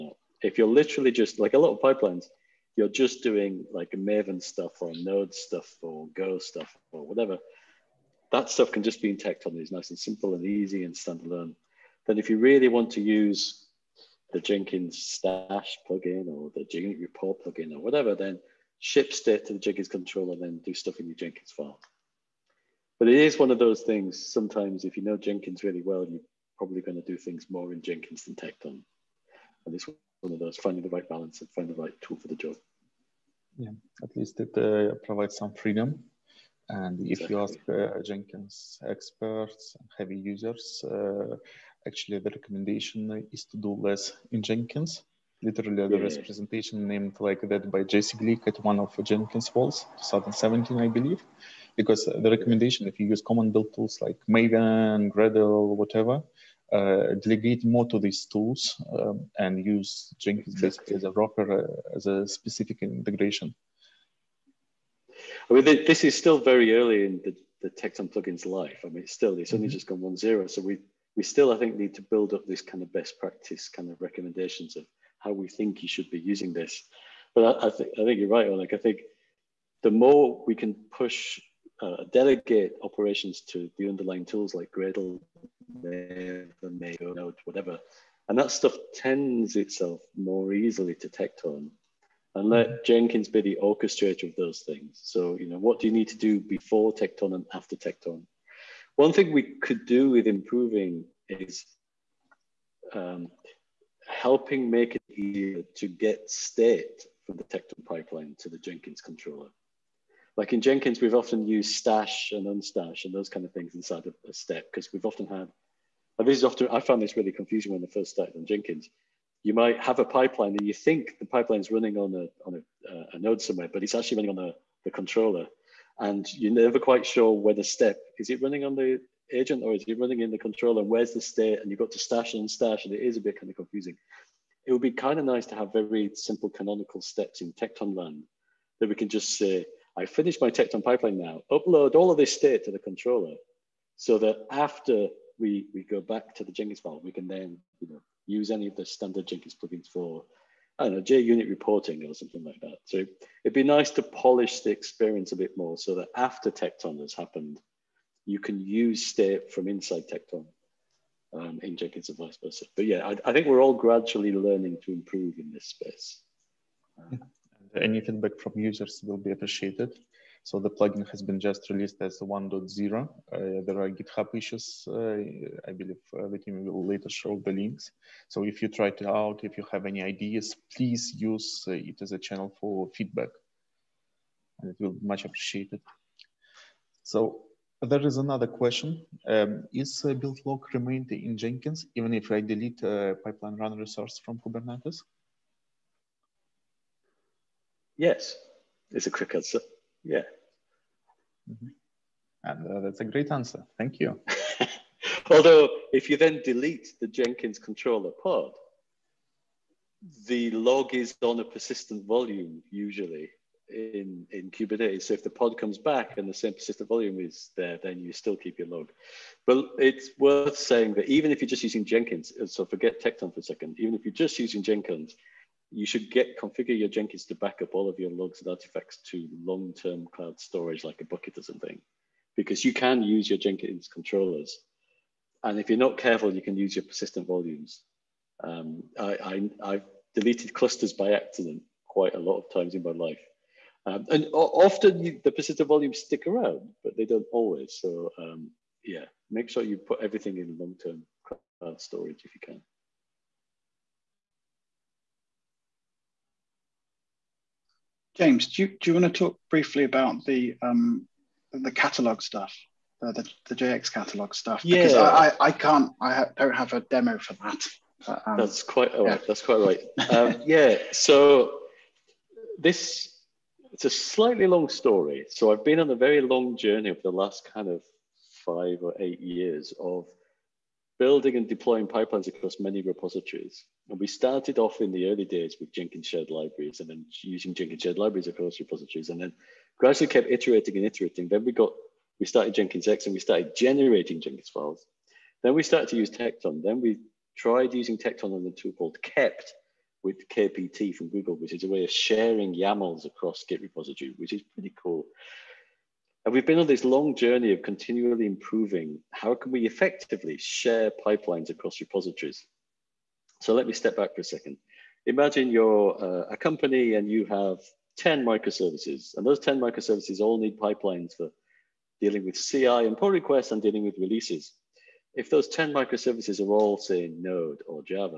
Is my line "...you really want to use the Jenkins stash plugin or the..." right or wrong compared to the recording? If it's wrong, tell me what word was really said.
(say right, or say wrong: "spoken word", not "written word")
right.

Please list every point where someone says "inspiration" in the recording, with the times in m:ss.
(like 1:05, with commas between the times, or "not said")
not said.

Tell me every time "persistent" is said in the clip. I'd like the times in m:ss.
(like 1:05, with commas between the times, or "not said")
3:31, 3:36, 3:56, 4:05.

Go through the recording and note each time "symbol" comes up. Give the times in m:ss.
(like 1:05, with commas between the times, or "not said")
not said.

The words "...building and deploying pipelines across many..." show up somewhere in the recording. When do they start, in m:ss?
4:40.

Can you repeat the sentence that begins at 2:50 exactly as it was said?
So the plugin has been just released as 1.0.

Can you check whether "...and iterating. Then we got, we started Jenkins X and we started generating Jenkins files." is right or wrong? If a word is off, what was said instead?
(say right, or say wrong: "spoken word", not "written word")
right.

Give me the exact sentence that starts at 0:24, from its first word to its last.
Sometimes, if you know Jenkins really well, you're probably going to do things more in Jenkins than Tekton.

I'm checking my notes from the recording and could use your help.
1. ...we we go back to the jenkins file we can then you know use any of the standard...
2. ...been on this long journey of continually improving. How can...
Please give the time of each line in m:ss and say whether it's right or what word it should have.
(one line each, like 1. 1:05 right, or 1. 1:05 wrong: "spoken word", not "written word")
1. 2:25 right
2. 5:06 right.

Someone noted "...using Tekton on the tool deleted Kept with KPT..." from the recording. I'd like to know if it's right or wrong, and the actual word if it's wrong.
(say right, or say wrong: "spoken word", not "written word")
wrong: "called", not "deleted".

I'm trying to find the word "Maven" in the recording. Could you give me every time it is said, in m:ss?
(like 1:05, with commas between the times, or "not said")
0:03, 0:54, 1:25.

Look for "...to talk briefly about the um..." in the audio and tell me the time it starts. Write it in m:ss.
4:19.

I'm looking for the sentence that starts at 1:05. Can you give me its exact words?
I mean, this is still very early in the, the Tekton plugin's life.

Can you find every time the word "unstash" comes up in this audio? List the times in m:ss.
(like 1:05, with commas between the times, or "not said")
1:52, 2:12.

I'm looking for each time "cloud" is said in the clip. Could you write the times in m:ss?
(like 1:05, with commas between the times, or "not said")
3:50, 4:11.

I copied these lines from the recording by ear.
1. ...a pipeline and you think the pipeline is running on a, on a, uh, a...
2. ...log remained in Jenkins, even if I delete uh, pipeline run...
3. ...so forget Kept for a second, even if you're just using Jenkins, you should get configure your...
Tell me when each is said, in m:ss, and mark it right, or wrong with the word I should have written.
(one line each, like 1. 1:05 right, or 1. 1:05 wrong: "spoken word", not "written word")
1. 1:59 right
2. 3:10 right
3. 3:42 wrong: "Tekton", not "Kept".